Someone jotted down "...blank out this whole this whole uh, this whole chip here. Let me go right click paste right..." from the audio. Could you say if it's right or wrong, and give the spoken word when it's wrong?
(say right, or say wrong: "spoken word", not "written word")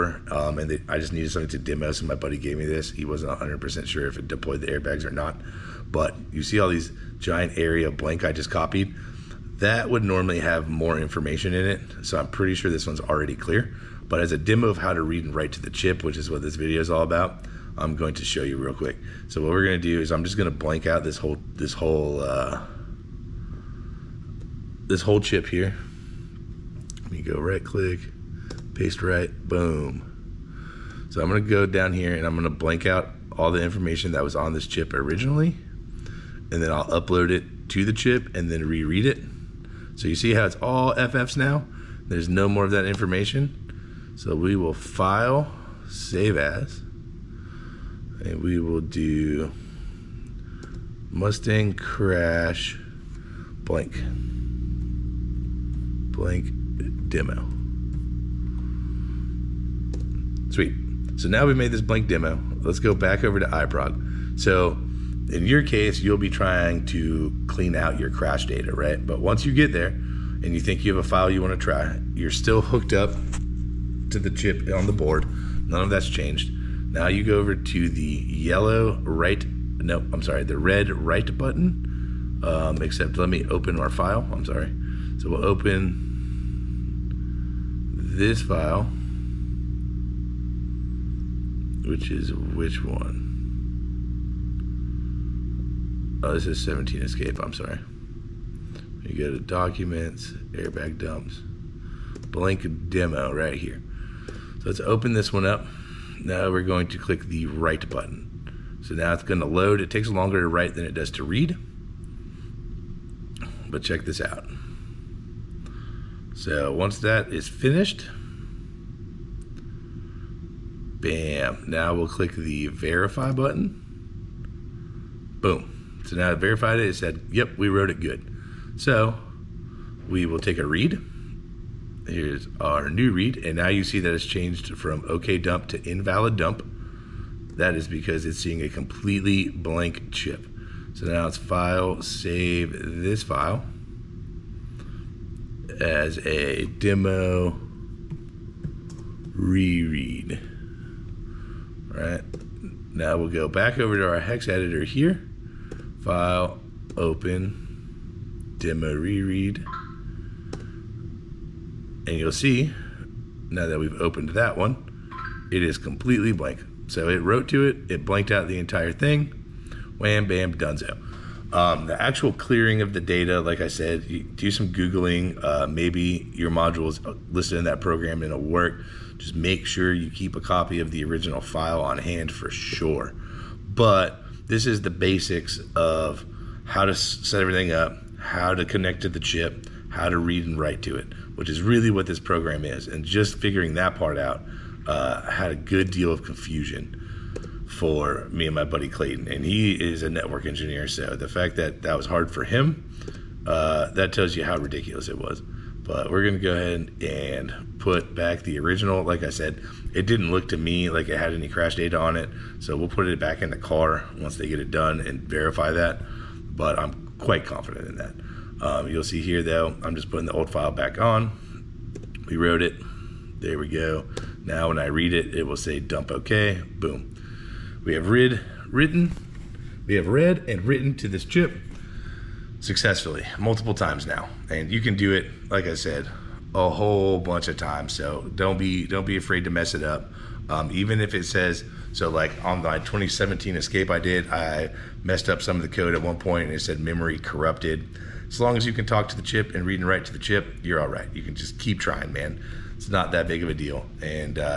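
right.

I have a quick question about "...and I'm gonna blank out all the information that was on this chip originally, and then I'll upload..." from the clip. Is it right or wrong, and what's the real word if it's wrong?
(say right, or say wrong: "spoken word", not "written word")
right.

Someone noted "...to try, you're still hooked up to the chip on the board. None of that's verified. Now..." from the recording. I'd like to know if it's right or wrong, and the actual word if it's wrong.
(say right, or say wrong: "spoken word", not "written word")
wrong: "changed", not "verified".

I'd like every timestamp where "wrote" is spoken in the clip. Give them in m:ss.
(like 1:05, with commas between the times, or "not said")
2:07, 2:47, 3:42.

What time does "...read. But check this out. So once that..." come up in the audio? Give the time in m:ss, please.
1:51.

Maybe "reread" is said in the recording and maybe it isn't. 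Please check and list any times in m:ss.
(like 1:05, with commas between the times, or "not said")
0:38, 2:29, 2:38.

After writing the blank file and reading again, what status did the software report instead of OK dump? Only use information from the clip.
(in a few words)
invalid dump.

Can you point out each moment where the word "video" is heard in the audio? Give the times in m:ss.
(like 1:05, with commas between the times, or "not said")
0:16.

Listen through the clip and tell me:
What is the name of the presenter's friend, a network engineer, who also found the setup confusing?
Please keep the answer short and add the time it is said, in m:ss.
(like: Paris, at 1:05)
Clayton, at 3:18.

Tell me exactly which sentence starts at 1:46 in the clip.
Now we're going to click the write button.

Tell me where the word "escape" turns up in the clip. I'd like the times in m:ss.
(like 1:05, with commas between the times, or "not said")
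1:36, 4:03.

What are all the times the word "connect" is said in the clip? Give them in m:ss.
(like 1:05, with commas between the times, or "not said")
3:08.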